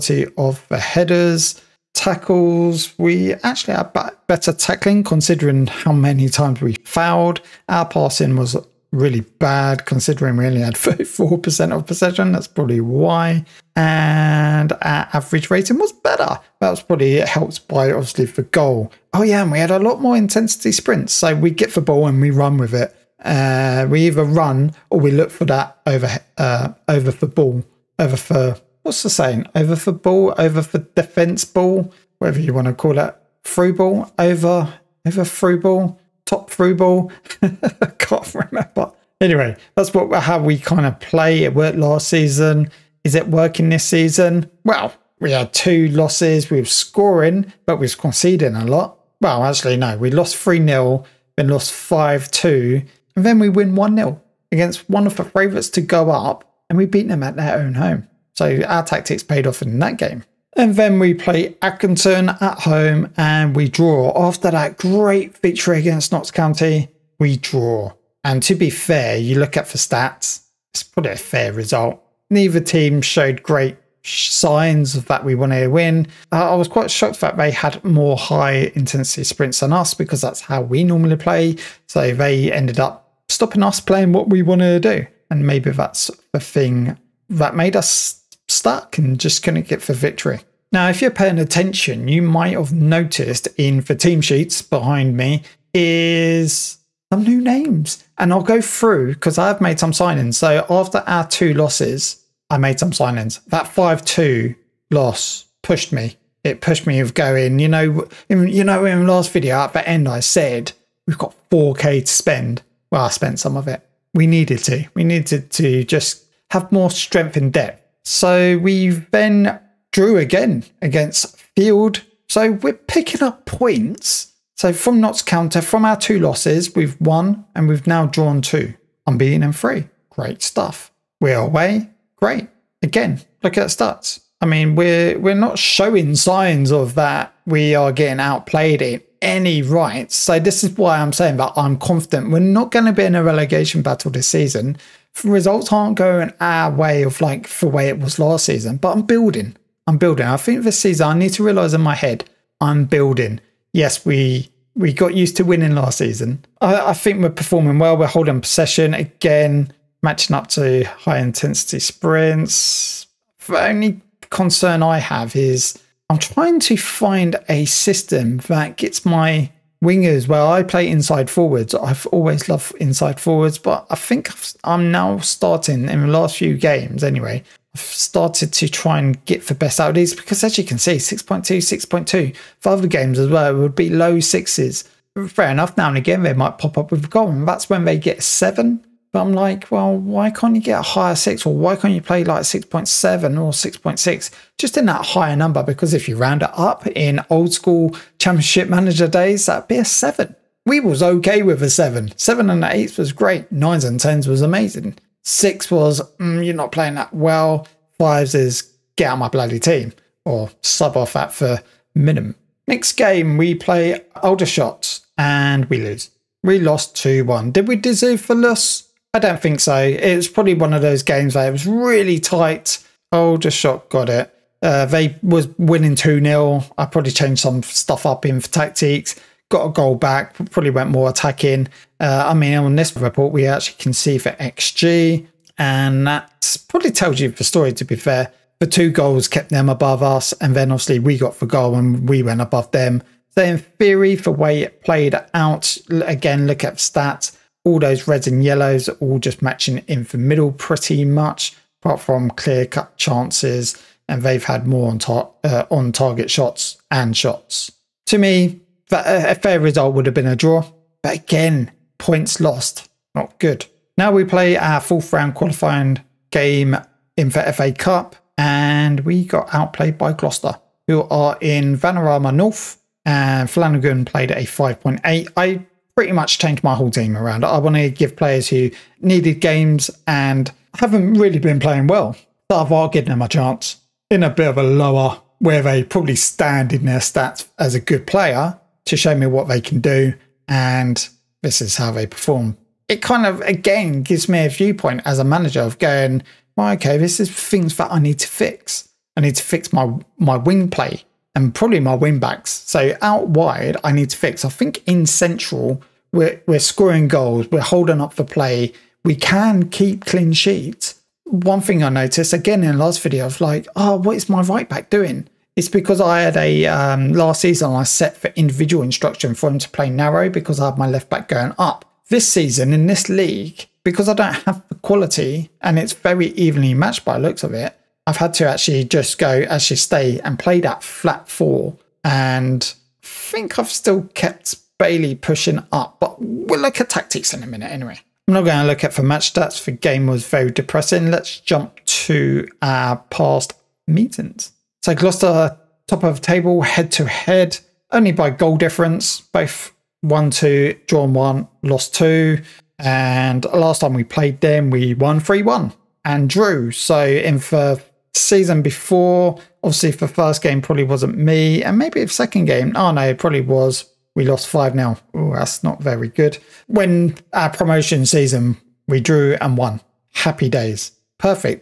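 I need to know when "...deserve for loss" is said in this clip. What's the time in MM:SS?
03:37.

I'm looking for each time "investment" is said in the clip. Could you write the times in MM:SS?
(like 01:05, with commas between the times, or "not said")
not said.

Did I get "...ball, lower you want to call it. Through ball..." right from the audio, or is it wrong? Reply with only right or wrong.
wrong.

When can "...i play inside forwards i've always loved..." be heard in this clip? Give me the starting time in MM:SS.
02:50.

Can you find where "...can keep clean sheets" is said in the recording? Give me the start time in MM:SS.
05:09.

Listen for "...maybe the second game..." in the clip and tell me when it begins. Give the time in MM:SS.
06:01.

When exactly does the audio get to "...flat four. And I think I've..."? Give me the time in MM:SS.
05:30.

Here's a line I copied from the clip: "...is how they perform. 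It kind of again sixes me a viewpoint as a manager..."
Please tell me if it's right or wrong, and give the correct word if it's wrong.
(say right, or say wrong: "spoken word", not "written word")
wrong: "gives", not "sixes".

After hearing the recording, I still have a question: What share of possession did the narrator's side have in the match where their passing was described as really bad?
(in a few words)
34%.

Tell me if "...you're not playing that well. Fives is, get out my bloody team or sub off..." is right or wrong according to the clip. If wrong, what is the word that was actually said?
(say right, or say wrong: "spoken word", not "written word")
right.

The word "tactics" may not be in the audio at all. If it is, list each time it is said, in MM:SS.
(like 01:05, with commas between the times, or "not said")
00:58, 03:48, 05:36.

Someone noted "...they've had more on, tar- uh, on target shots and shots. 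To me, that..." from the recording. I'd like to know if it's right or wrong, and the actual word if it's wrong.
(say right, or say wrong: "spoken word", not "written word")
right.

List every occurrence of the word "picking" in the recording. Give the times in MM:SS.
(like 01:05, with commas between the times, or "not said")
02:02.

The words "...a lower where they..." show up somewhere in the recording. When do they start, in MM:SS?
04:44.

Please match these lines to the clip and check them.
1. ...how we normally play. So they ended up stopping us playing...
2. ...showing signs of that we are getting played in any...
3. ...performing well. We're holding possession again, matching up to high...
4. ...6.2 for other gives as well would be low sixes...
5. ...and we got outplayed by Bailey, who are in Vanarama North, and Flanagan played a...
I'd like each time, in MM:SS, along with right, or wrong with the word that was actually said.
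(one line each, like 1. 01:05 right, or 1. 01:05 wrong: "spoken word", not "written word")
1. 01:20 right
2. 02:15 wrong: "outplayed", not "played"
3. 02:37 right
4. 03:01 wrong: "games", not "gives"
5. 04:28 wrong: "Gloucester", not "Bailey".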